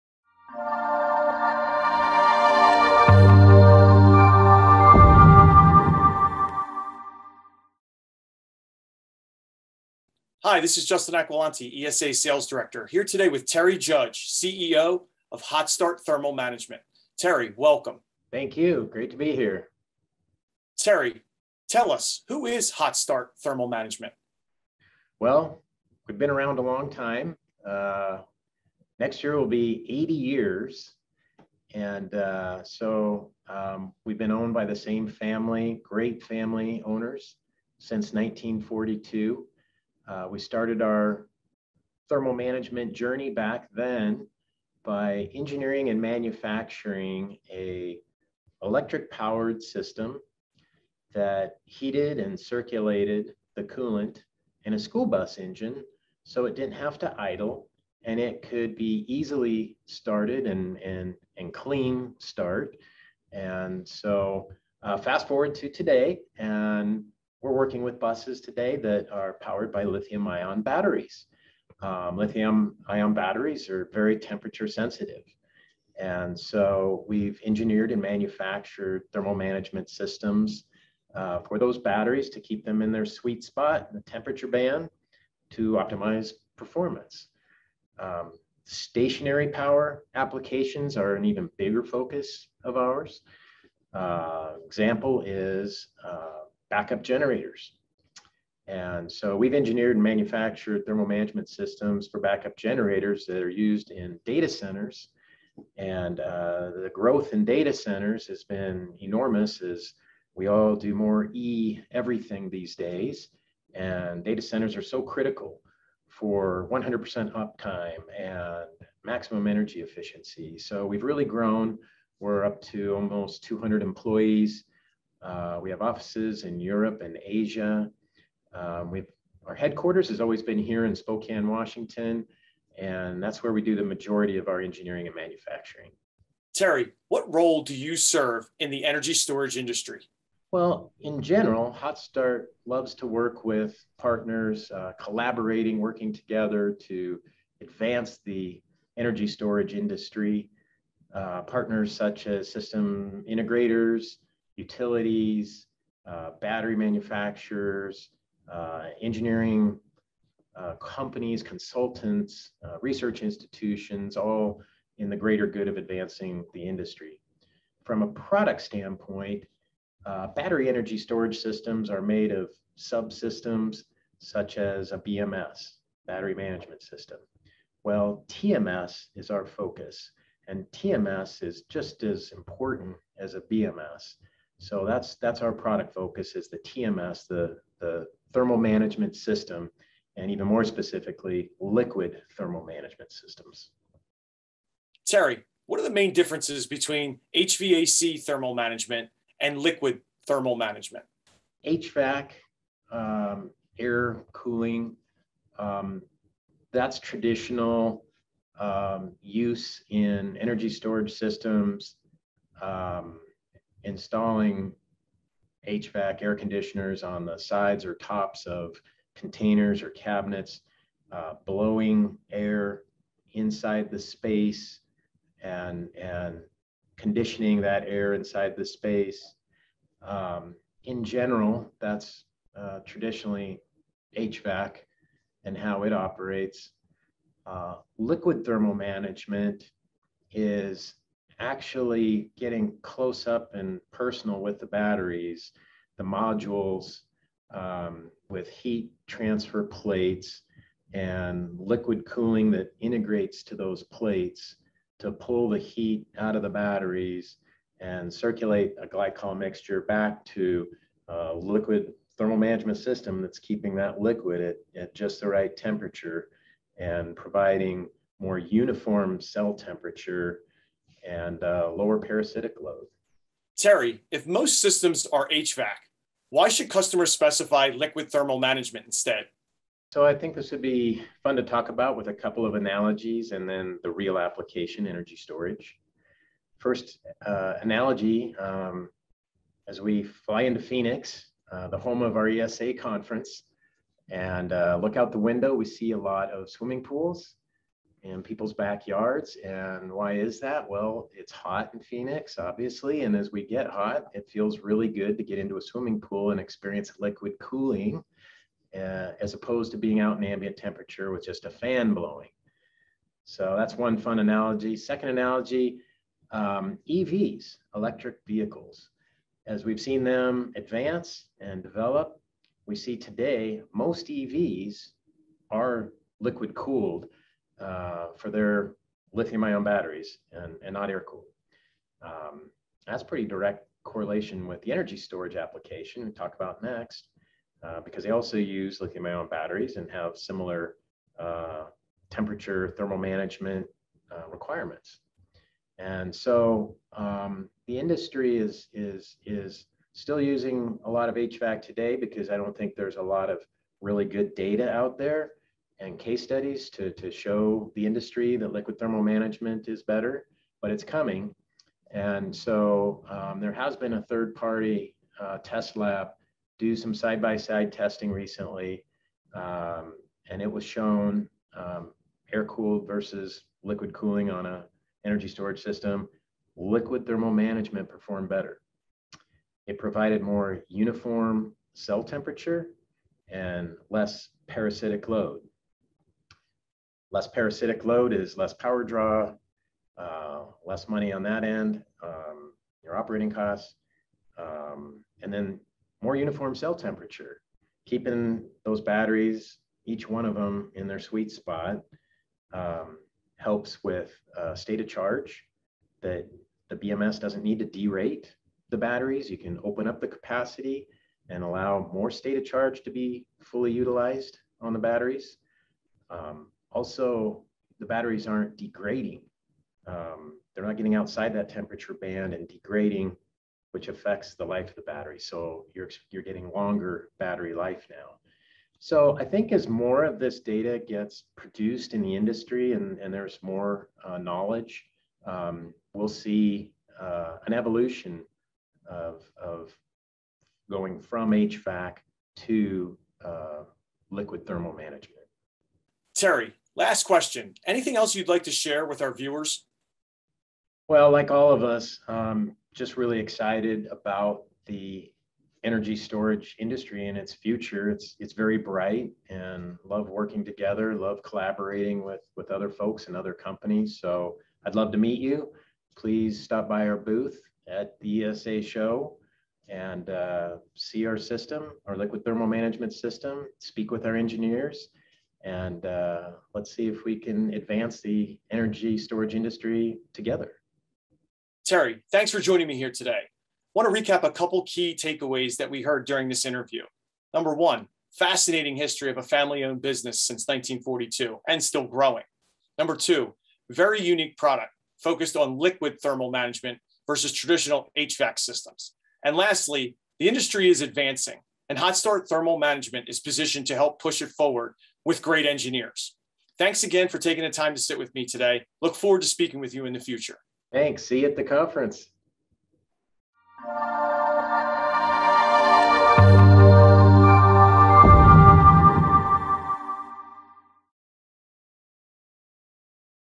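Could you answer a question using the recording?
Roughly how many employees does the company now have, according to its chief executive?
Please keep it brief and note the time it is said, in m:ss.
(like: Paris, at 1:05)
almost 200, at 2:02.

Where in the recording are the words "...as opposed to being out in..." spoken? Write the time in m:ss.
5:09.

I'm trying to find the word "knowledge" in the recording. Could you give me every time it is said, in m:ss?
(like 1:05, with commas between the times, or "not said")
7:14.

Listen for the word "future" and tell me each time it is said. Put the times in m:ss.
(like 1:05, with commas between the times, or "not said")
7:37, 8:29.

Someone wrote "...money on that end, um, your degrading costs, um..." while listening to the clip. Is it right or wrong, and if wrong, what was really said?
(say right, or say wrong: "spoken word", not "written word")
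wrong: "operating", not "degrading".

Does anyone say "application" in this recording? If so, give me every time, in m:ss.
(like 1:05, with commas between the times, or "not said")
1:30, 4:44, 5:35.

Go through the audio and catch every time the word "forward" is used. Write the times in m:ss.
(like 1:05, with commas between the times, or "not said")
1:05, 8:24, 8:28.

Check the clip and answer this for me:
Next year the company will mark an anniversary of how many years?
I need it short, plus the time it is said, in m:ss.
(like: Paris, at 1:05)
80, at 0:29.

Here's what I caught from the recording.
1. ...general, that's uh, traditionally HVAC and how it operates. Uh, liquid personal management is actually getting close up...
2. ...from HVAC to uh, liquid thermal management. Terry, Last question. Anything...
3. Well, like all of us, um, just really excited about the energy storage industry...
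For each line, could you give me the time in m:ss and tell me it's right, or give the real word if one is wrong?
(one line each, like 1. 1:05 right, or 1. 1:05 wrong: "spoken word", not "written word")
1. 3:51 wrong: "thermal", not "personal"
2. 7:20 right
3. 7:30 right.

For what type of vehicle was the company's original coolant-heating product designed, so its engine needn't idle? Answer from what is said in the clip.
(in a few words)
school bus.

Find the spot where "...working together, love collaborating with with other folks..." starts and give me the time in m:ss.
7:40.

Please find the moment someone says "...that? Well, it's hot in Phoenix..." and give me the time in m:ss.
5:00.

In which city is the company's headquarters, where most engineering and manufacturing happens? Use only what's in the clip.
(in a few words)
Spokane, Washington.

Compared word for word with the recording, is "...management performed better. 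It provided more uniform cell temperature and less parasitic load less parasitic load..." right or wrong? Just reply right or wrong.
right.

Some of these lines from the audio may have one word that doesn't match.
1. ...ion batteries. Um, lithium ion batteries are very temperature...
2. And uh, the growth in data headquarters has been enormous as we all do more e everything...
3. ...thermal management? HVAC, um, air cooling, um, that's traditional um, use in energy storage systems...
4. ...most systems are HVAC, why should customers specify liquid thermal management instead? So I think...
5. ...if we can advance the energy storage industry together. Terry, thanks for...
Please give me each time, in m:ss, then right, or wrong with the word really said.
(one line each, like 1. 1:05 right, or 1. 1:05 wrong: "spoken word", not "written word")
1. 1:10 right
2. 1:45 wrong: "centers", not "headquarters"
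3. 3:20 right
4. 4:34 right
5. 7:56 right.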